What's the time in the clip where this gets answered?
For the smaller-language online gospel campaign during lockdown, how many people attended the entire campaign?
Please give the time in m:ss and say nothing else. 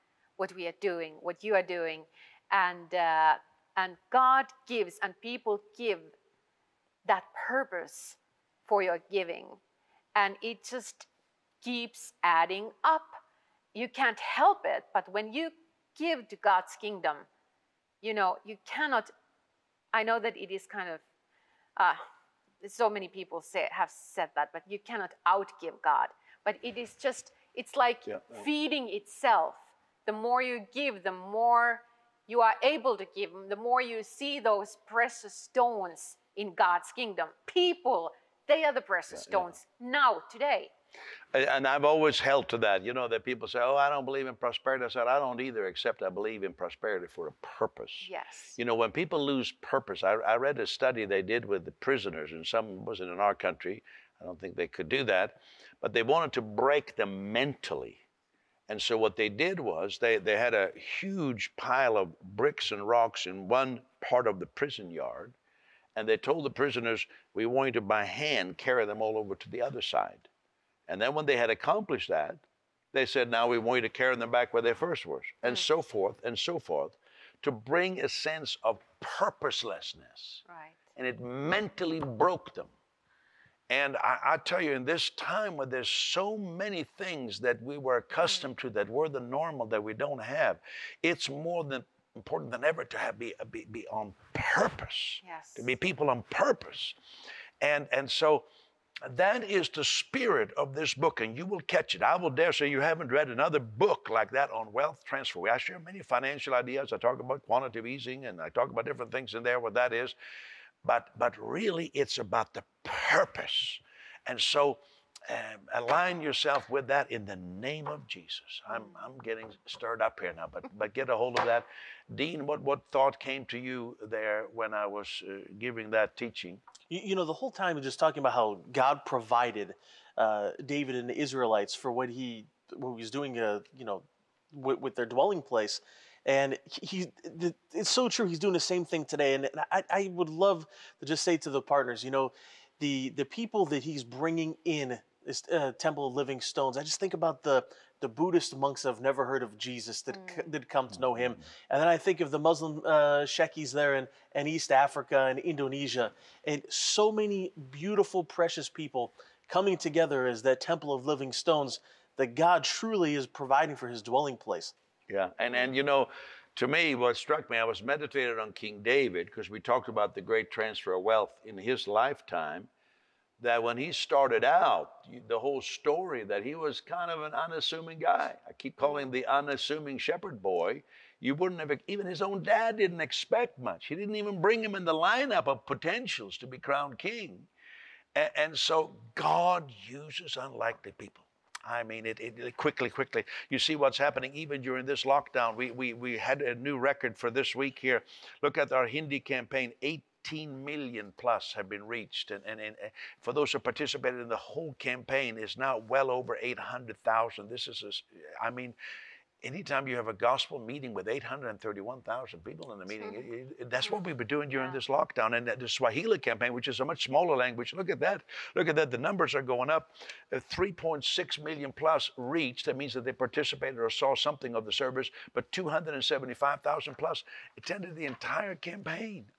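3:45.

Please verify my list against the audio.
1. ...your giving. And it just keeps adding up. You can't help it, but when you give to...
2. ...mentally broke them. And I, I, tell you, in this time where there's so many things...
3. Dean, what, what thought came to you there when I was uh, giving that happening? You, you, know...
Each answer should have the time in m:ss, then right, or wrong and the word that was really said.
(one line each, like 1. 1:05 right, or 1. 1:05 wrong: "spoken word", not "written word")
1. 0:08 right
2. 1:21 right
3. 2:02 wrong: "teaching", not "happening".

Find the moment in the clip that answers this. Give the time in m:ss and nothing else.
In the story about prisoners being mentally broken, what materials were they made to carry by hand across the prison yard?
1:02.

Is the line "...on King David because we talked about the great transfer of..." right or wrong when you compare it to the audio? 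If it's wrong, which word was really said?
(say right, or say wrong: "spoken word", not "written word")
right.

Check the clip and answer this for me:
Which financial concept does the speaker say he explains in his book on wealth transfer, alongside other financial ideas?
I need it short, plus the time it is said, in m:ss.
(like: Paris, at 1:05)
Quantitative easing, at 1:47.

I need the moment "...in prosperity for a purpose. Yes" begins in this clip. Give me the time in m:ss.
0:46.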